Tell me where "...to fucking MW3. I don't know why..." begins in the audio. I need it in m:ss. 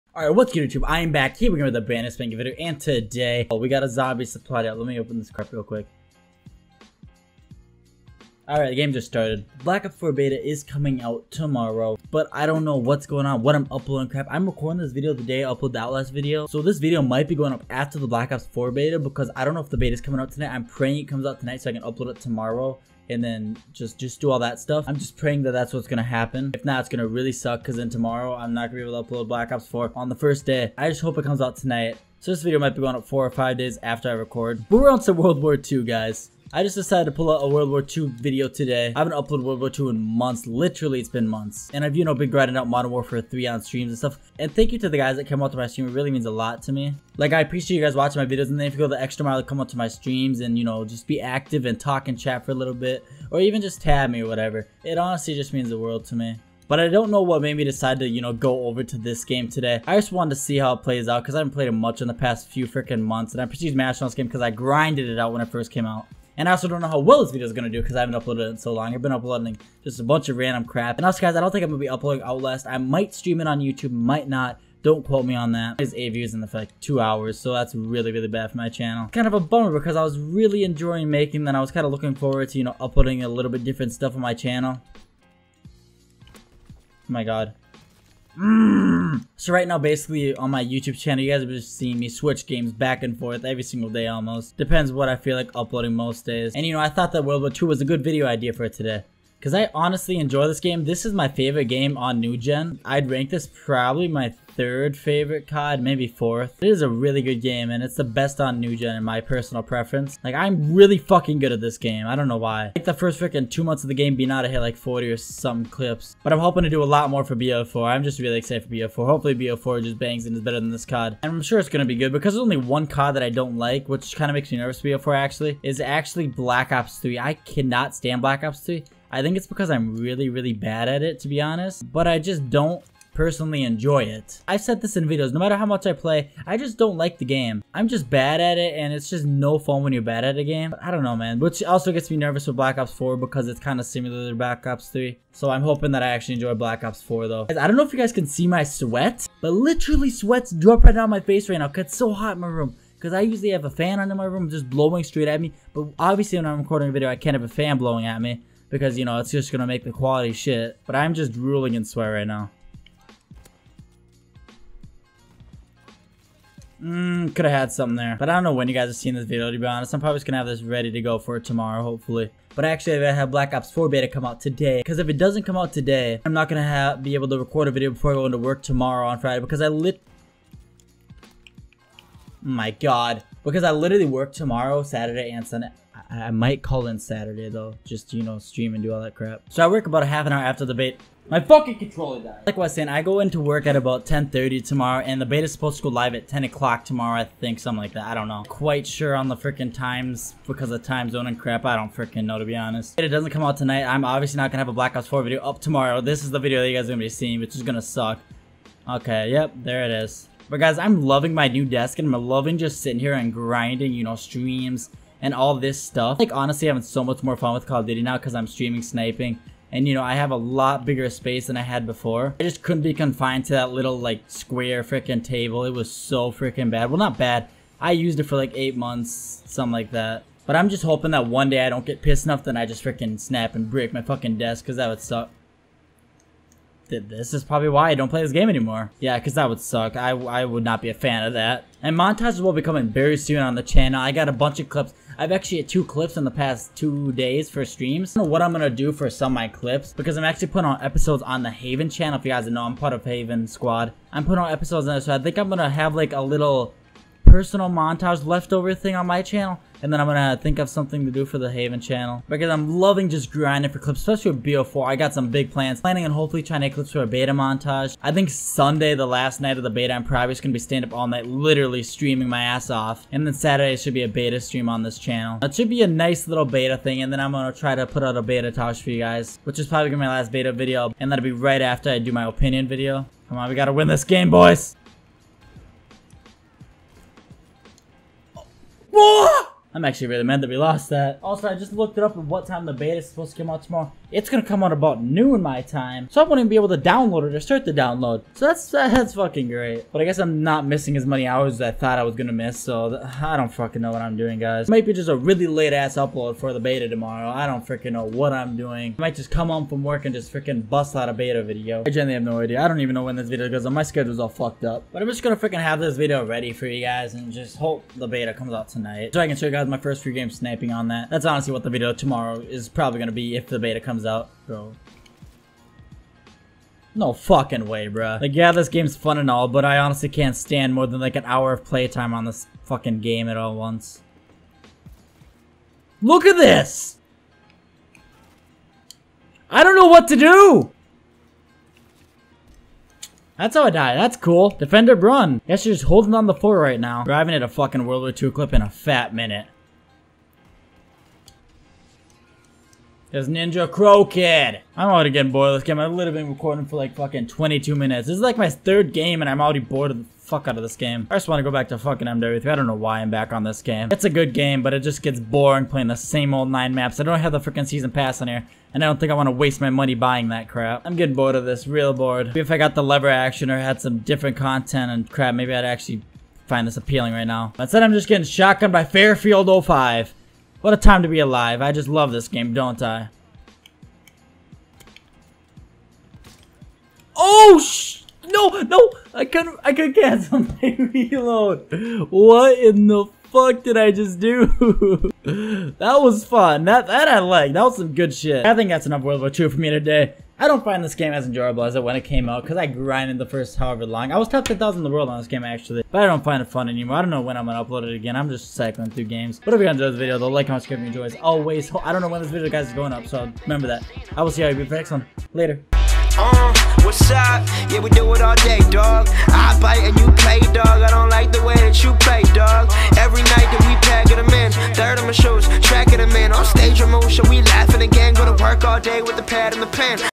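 6:01.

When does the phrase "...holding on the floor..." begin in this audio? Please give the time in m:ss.
5:45.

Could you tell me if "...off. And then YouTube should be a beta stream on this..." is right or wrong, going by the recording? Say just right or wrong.
wrong.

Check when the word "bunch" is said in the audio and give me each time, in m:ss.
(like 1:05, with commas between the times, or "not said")
1:10, 4:04.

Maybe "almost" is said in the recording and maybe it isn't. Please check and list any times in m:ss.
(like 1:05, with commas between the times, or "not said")
1:34.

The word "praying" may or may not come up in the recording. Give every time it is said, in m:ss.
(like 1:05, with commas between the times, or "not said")
0:20, 0:25.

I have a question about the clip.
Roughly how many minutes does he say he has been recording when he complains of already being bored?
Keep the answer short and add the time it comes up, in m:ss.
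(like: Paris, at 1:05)
22, at 5:57.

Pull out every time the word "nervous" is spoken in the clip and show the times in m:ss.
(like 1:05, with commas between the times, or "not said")
2:04, 2:22.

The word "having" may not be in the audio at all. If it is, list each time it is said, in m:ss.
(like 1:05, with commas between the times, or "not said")
3:36.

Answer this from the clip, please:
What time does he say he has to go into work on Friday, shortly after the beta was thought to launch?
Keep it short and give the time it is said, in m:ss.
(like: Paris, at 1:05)
10:30, at 3:14.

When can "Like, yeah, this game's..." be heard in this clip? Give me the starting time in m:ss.
5:28.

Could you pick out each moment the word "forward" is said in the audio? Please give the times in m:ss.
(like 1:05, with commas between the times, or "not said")
1:22.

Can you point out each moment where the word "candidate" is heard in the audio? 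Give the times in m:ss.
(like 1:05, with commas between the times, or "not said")
not said.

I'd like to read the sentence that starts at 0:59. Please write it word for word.
I just wanted to see how it plays out because I haven't played it much in the past few freaking months.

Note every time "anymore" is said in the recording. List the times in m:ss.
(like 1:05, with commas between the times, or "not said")
3:58, 6:46.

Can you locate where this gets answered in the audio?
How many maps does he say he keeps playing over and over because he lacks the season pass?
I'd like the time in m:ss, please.
6:06.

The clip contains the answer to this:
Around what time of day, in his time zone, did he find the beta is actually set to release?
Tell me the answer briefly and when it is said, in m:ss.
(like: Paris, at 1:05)
noon, at 4:55.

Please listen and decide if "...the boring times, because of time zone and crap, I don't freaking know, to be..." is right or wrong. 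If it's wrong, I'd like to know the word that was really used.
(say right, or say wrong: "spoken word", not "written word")
wrong: "freaking", not "boring".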